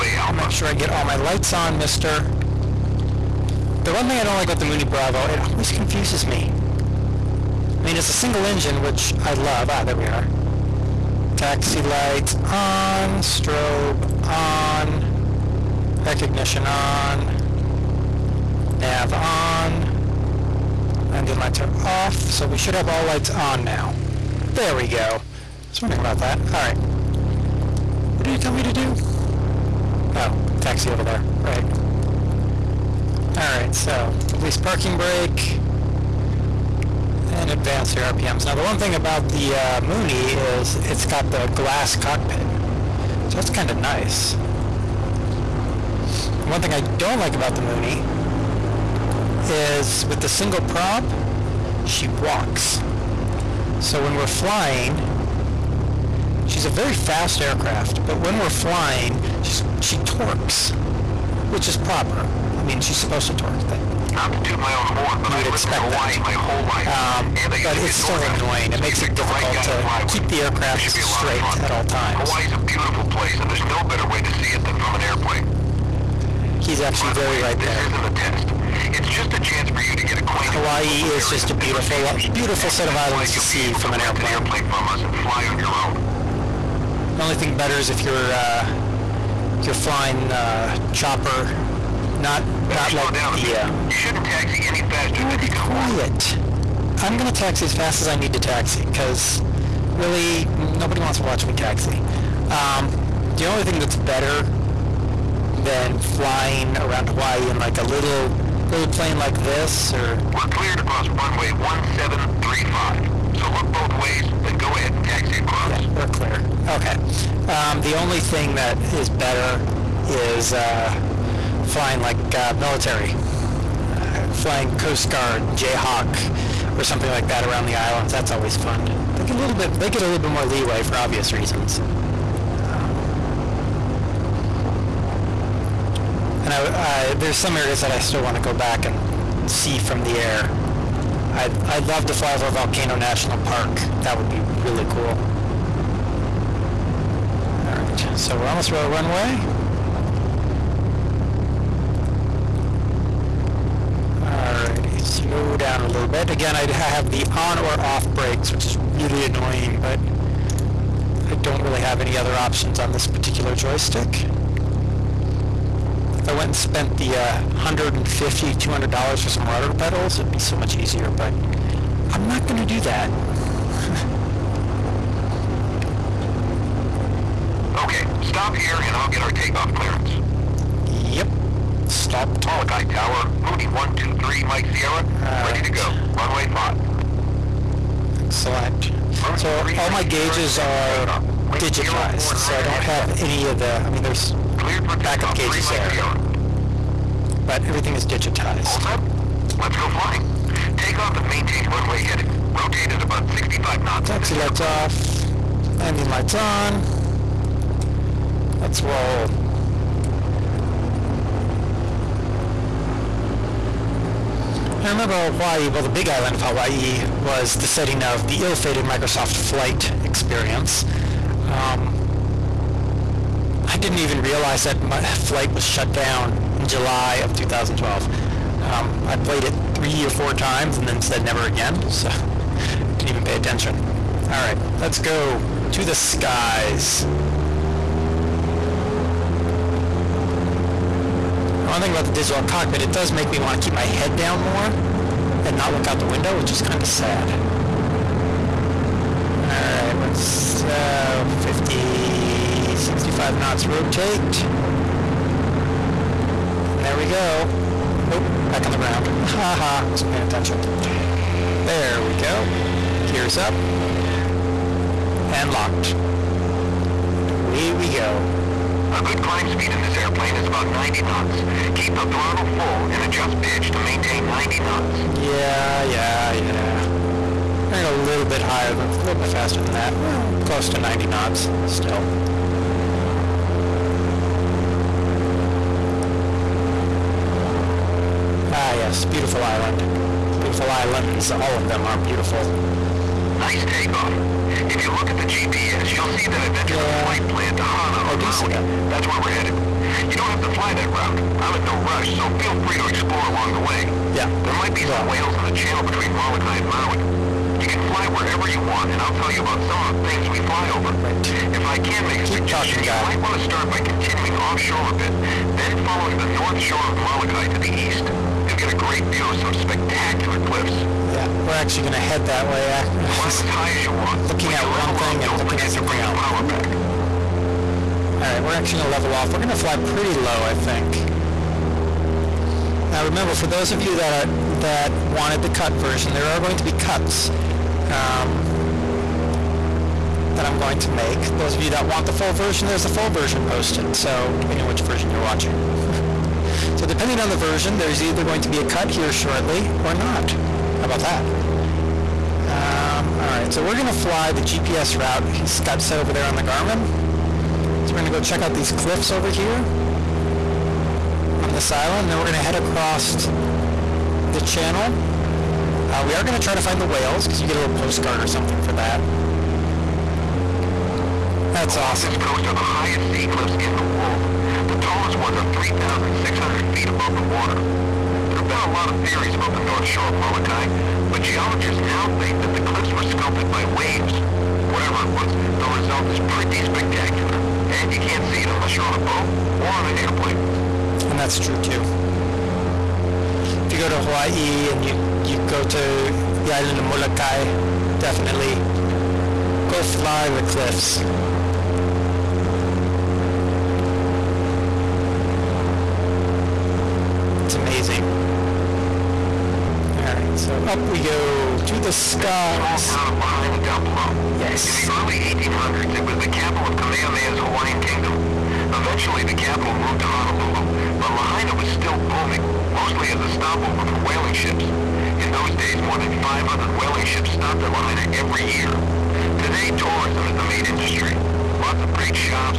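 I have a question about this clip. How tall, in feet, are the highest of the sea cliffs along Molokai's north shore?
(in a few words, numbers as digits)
3,600 feet.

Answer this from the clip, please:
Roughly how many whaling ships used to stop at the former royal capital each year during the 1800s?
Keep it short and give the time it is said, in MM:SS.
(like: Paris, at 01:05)
more than 500, at 07:05.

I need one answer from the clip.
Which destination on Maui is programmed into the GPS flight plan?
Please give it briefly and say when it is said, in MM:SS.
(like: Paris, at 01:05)
Hana, at 04:57.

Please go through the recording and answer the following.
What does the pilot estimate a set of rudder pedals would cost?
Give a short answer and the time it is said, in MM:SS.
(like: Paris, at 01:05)
$150 to $200, at 02:47.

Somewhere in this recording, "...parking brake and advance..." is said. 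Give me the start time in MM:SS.
00:34.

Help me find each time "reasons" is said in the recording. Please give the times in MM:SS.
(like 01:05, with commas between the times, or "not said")
02:11.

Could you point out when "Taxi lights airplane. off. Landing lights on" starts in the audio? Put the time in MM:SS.
03:24.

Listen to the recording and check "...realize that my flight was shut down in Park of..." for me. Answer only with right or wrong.
wrong.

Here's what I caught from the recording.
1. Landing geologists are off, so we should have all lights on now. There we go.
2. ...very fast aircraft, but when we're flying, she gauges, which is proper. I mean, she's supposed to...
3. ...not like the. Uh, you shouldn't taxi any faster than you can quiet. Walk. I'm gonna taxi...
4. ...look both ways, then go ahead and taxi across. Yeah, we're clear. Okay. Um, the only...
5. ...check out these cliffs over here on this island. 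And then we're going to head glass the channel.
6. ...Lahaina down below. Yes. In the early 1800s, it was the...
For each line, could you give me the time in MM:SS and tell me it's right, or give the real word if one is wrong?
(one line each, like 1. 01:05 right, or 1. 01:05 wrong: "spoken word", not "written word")
1. 00:21 wrong: "lights", not "geologists"
2. 00:56 wrong: "torques", not "gauges"
3. 01:32 right
4. 01:53 right
5. 05:58 wrong: "across", not "glass"
6. 06:53 right.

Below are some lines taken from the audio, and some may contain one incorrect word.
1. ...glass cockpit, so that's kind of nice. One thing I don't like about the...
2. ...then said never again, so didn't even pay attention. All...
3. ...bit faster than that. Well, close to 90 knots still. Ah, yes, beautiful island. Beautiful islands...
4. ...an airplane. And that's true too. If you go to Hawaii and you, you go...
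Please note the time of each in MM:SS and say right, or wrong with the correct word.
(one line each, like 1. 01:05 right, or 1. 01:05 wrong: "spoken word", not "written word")
1. 00:41 right
2. 03:50 right
3. 04:39 right
4. 06:29 right.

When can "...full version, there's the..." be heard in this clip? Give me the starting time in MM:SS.
05:42.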